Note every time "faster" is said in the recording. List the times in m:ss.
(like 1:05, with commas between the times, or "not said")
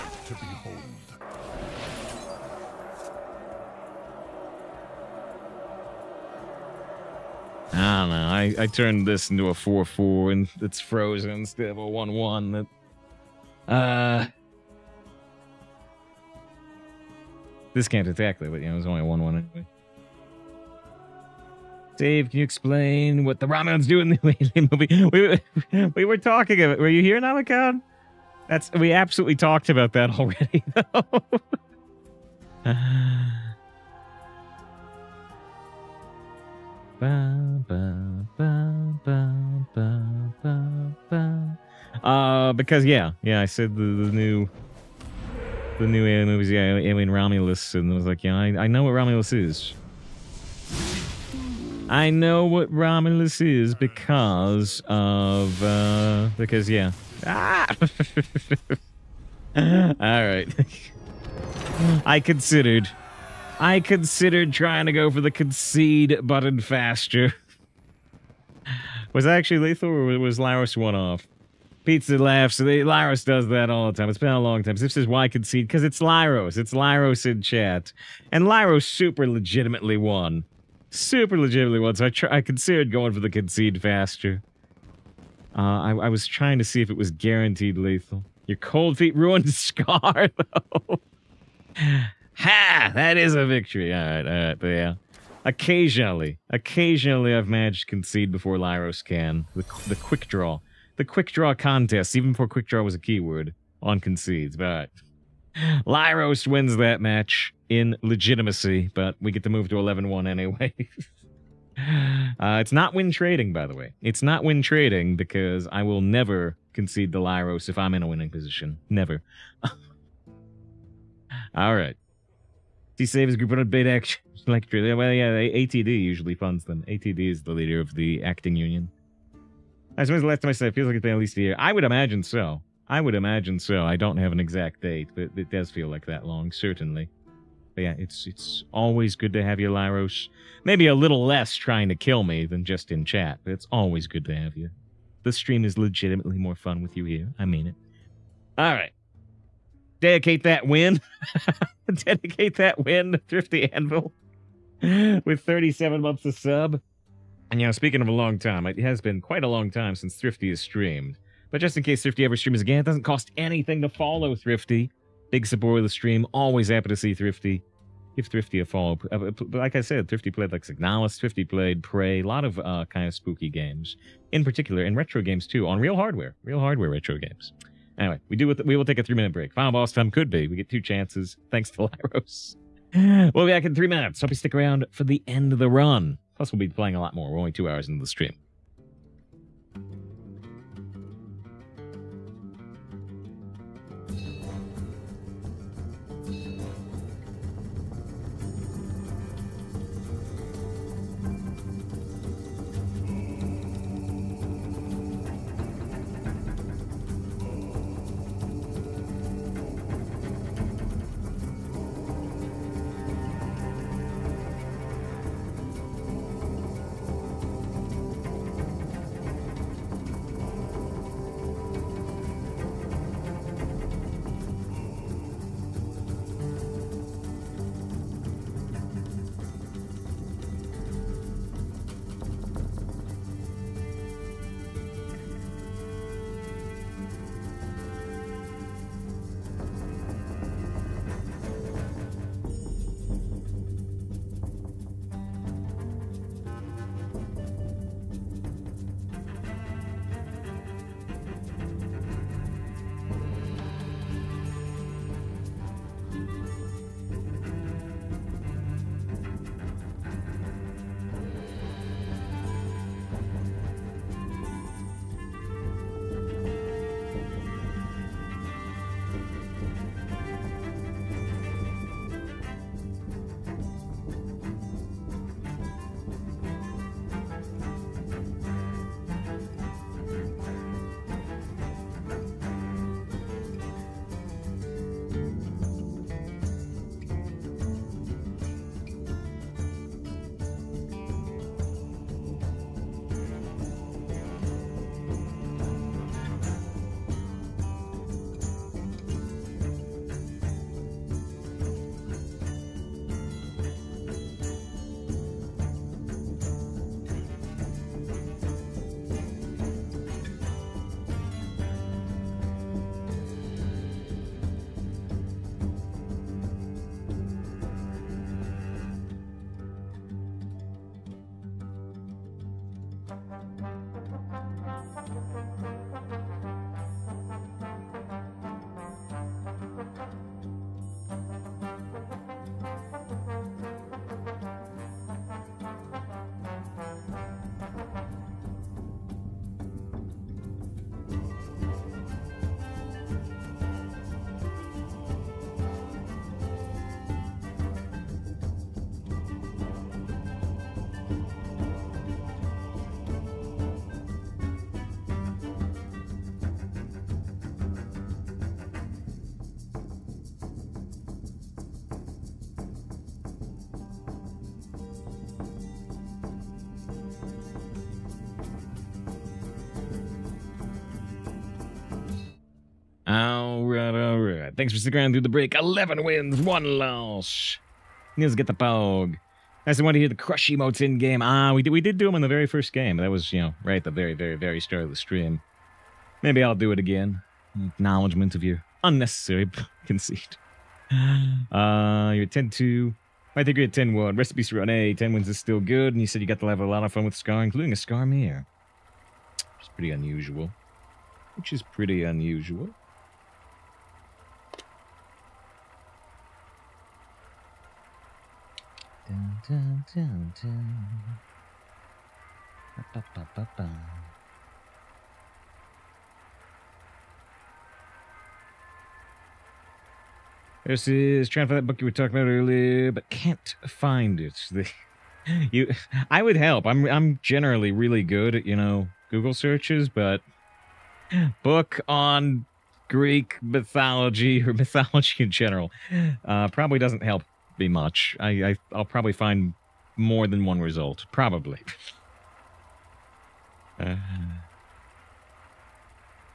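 1:06, 1:23.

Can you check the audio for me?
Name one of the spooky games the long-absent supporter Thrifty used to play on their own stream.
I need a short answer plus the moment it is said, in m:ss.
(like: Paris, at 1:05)
Signalis, at 2:50.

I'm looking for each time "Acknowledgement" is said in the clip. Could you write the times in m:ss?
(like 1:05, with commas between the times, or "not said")
6:27.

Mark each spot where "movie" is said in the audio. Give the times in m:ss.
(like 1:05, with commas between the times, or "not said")
0:25, 0:46.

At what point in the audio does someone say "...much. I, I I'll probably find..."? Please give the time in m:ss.
7:17.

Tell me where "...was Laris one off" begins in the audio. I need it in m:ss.
1:10.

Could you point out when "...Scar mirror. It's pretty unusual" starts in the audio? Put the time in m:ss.
6:37.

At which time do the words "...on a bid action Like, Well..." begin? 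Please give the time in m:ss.
2:03.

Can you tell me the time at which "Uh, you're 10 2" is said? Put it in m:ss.
6:31.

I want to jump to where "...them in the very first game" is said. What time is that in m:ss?
6:22.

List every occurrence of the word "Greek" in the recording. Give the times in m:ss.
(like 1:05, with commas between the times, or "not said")
7:12.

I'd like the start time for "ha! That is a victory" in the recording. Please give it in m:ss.
1:32.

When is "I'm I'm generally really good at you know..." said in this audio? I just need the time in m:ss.
7:06.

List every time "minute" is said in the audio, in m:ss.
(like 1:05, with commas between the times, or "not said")
2:59, 3:03.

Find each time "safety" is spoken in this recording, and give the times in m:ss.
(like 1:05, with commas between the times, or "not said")
not said.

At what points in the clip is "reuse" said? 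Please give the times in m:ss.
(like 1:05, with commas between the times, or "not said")
not said.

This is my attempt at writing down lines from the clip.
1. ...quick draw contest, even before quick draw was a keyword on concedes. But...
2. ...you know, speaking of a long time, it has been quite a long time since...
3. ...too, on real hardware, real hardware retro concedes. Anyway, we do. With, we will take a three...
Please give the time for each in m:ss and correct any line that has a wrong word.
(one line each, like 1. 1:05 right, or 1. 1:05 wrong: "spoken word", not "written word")
1. 1:41 right
2. 2:37 right
3. 2:55 wrong: "games", not "concedes".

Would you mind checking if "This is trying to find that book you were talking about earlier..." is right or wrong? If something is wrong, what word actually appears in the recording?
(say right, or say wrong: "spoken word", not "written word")
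right.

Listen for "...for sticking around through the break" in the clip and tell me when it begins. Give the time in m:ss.
6:14.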